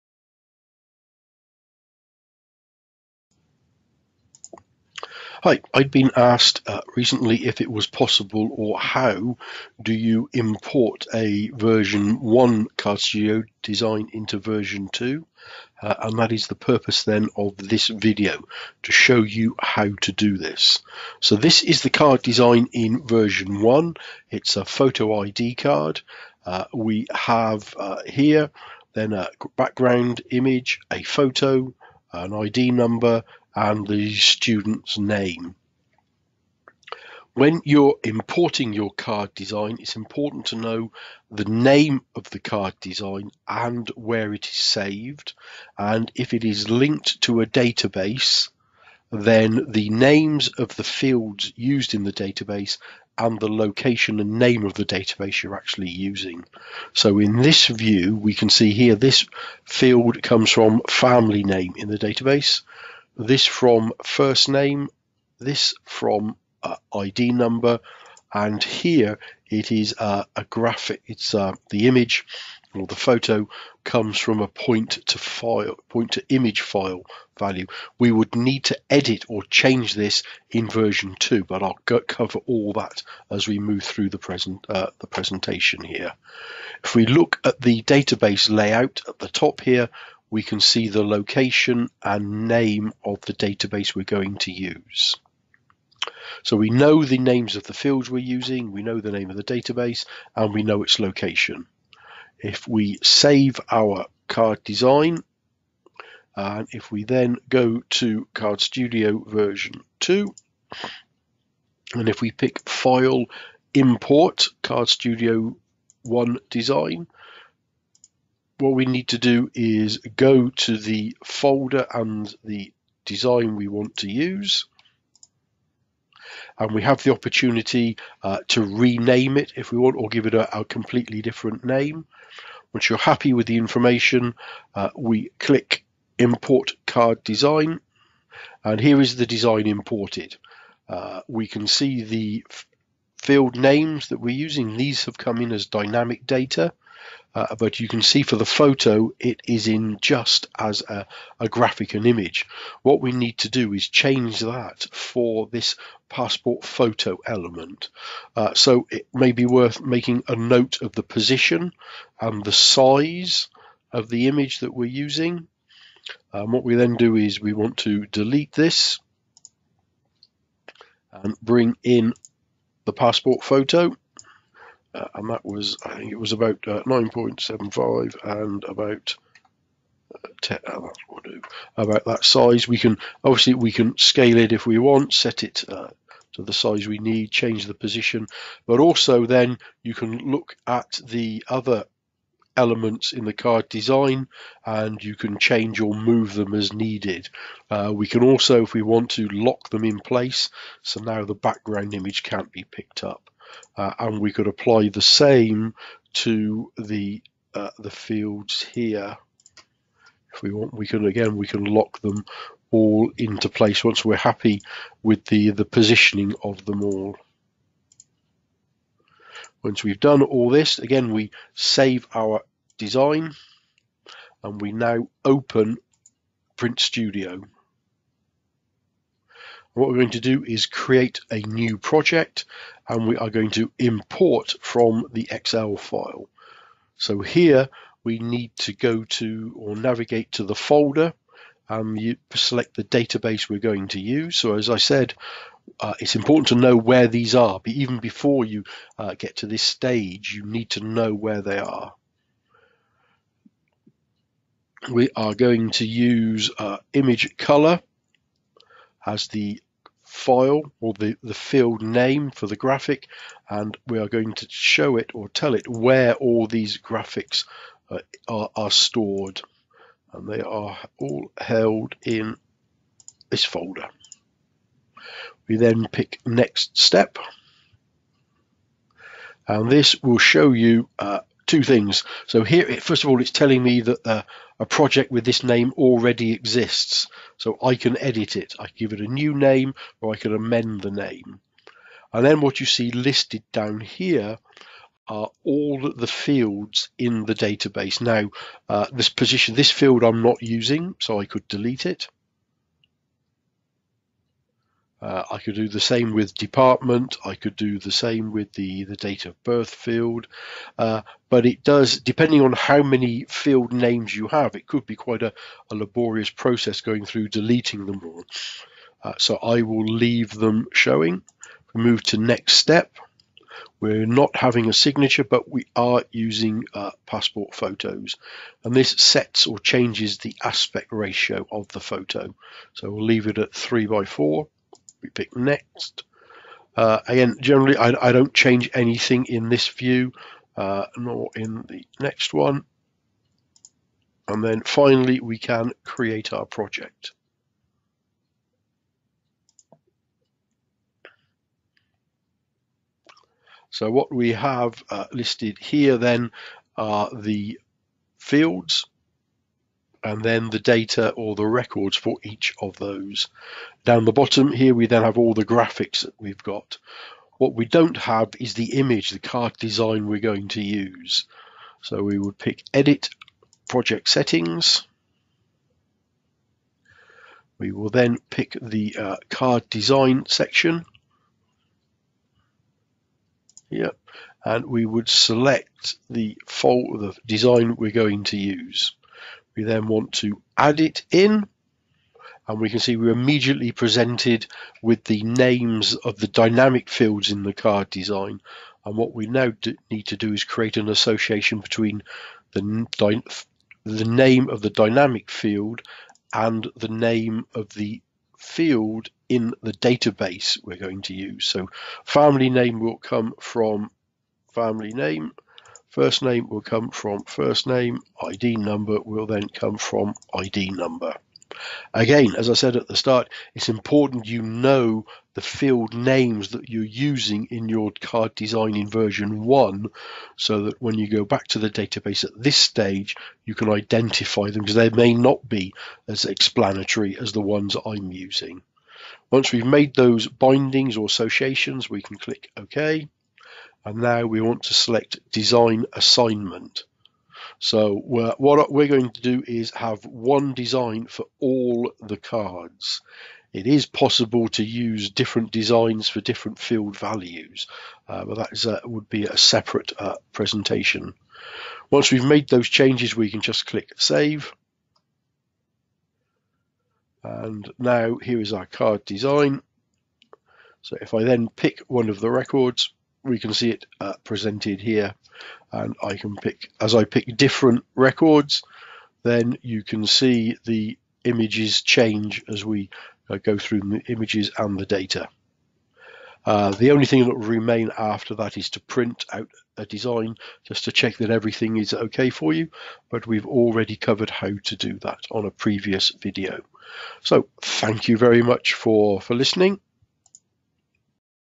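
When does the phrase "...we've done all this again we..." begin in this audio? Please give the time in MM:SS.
03:39.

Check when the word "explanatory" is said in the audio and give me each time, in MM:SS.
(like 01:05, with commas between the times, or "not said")
07:16.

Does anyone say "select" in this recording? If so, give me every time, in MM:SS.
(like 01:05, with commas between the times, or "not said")
04:02, 06:25, 07:24.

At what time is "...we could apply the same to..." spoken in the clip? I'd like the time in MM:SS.
03:24.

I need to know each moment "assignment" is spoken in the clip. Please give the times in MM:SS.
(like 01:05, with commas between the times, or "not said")
07:25.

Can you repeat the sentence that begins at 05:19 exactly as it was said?
Uh, so I will leave them showing.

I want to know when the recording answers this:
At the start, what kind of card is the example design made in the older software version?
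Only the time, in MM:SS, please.
00:24.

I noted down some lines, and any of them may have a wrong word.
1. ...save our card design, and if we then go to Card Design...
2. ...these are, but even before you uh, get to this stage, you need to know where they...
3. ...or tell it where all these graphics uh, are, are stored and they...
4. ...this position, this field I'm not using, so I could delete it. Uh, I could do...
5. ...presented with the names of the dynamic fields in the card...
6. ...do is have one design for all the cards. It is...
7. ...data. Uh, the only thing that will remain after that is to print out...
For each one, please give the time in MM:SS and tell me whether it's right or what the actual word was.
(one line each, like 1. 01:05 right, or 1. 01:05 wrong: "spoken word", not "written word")
1. 01:43 wrong: "Studio", not "Design"
2. 04:07 right
3. 04:25 right
4. 04:58 right
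5. 06:33 right
6. 07:29 right
7. 08:04 right.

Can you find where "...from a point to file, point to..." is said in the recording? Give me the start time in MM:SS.
01:14.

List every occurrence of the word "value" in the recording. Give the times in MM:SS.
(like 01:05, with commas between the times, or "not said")
01:17, 07:36.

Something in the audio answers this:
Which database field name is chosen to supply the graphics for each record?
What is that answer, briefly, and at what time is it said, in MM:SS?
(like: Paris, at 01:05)
image color, at 04:16.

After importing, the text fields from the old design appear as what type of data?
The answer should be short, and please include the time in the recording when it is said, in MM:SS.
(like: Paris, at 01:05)
Dynamic data, at 02:25.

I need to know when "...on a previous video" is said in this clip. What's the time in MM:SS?
08:15.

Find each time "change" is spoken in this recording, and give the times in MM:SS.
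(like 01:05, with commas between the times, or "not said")
01:19, 02:33, 03:07, 03:15, 05:29, 05:38, 07:42, 08:01.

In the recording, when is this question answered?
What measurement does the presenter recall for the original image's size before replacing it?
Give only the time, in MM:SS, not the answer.
02:56.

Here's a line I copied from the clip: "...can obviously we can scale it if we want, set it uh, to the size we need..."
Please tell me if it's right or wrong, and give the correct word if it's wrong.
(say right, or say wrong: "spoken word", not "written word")
right.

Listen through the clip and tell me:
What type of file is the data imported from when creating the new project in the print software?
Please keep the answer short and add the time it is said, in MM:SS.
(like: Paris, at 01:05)
Excel file, at 03:55.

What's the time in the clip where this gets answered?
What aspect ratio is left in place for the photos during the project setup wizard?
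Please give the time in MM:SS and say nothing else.
05:33.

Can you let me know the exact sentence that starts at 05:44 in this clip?
And then finally, we can create our project.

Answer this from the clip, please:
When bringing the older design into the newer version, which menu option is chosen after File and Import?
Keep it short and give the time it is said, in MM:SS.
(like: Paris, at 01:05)
Card Studio 1 Design, at 01:54.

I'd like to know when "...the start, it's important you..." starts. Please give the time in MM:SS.
07:02.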